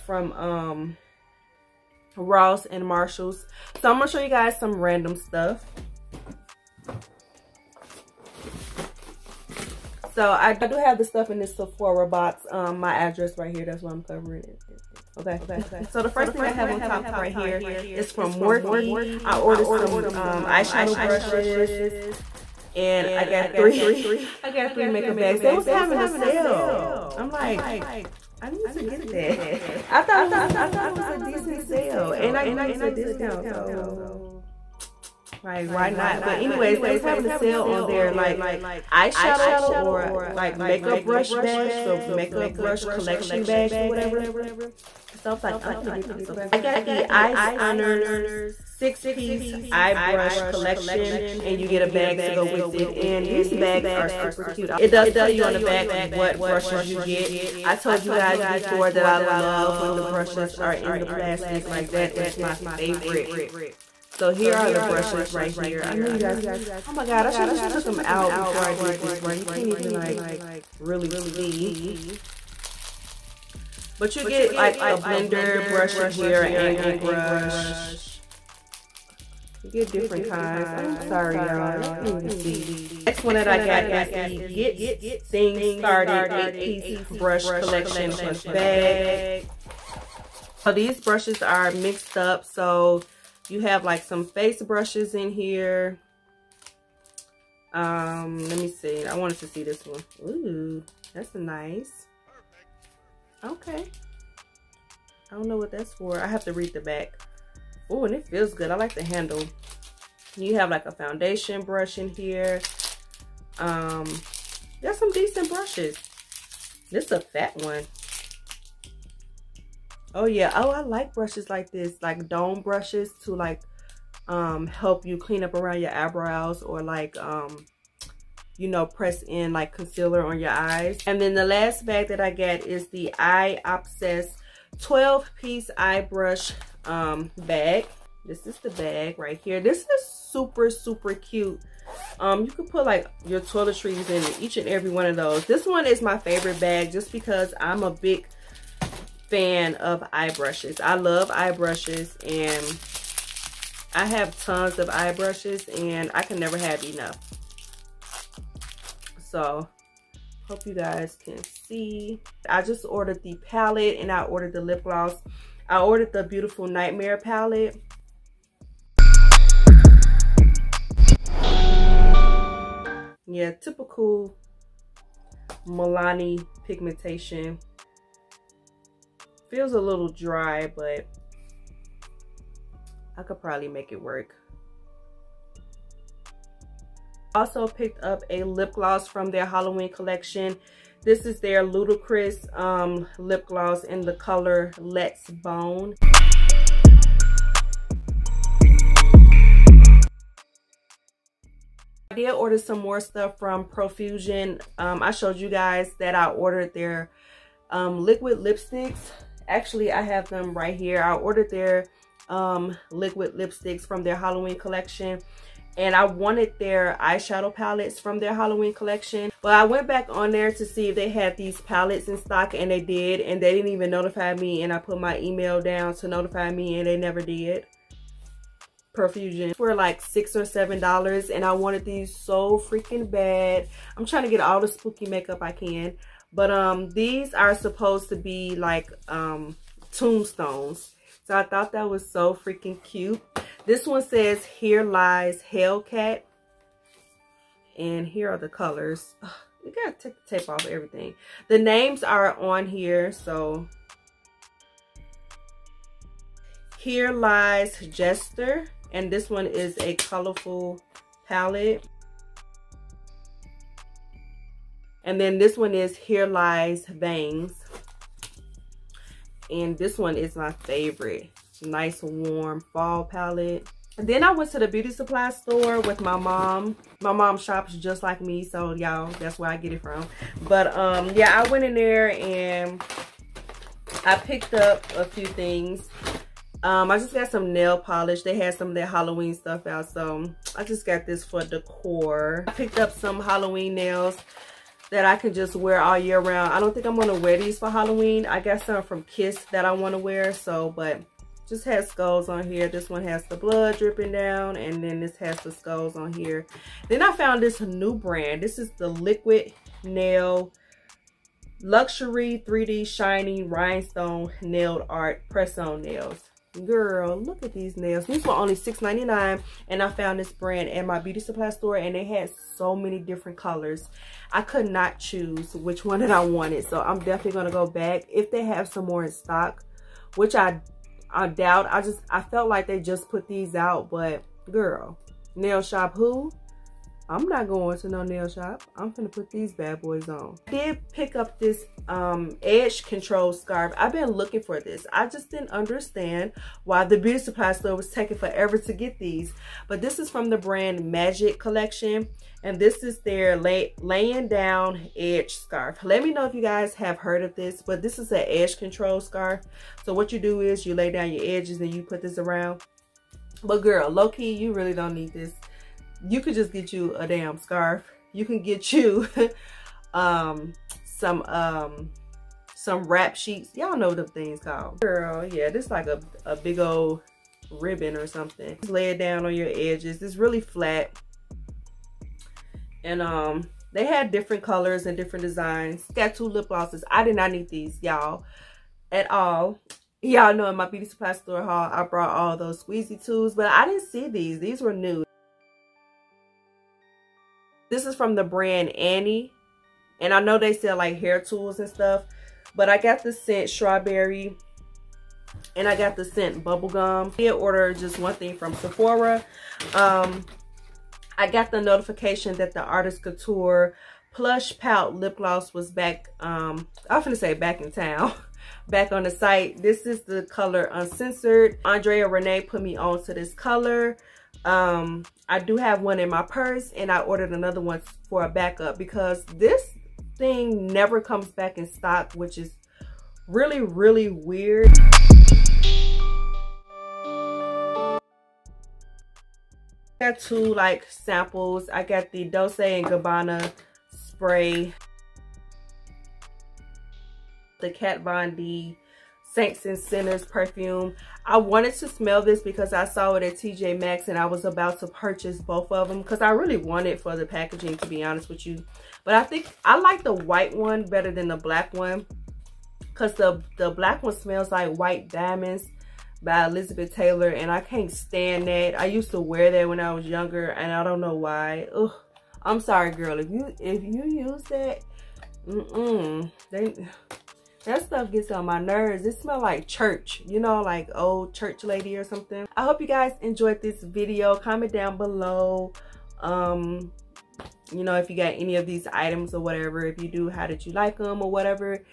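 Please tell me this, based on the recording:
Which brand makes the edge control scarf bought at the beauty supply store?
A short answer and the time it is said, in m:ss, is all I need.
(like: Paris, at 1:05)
Magic Collection, at 5:50.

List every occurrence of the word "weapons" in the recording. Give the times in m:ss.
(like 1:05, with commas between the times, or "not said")
not said.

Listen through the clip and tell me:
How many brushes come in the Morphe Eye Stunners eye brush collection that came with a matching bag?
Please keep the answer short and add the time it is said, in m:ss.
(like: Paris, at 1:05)
6, at 0:48.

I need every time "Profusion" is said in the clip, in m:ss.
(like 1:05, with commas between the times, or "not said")
3:23, 3:48.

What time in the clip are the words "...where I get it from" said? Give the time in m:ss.
4:39.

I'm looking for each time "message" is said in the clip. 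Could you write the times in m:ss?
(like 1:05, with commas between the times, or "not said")
not said.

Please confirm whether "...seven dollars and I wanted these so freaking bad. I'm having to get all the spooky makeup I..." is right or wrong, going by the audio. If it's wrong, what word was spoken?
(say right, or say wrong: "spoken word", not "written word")
wrong: "trying", not "having".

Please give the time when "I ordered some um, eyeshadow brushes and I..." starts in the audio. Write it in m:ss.
0:19.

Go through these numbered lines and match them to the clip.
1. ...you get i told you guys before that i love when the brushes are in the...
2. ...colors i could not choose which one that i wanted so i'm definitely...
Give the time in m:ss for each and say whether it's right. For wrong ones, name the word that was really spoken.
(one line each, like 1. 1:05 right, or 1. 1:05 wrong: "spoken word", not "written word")
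1. 0:56 right
2. 5:23 right.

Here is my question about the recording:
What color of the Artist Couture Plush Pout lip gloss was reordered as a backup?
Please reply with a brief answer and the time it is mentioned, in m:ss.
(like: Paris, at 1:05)
Uncensored, at 7:00.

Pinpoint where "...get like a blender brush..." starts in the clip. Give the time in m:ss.
1:14.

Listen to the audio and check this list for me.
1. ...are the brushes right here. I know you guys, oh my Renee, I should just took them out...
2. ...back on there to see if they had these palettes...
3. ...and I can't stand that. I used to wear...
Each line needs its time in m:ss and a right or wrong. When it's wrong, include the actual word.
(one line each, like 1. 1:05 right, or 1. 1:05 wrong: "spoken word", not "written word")
1. 1:04 wrong: "God", not "Renee"
2. 3:39 right
3. 7:47 right.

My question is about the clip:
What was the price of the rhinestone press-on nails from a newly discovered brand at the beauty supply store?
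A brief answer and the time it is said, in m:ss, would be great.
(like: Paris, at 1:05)
$6.99, at 5:18.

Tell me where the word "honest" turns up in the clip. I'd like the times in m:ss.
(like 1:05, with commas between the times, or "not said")
7:38.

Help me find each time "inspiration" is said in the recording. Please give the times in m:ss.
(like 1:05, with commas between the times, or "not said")
not said.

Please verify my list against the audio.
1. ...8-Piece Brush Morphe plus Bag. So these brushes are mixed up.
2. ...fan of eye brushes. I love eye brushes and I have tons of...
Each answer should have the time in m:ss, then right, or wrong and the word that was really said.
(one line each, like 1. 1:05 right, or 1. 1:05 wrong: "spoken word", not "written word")
1. 1:26 wrong: "Collection", not "Morphe"
2. 2:29 right.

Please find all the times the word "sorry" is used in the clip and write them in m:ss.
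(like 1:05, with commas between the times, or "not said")
1:20, 7:52.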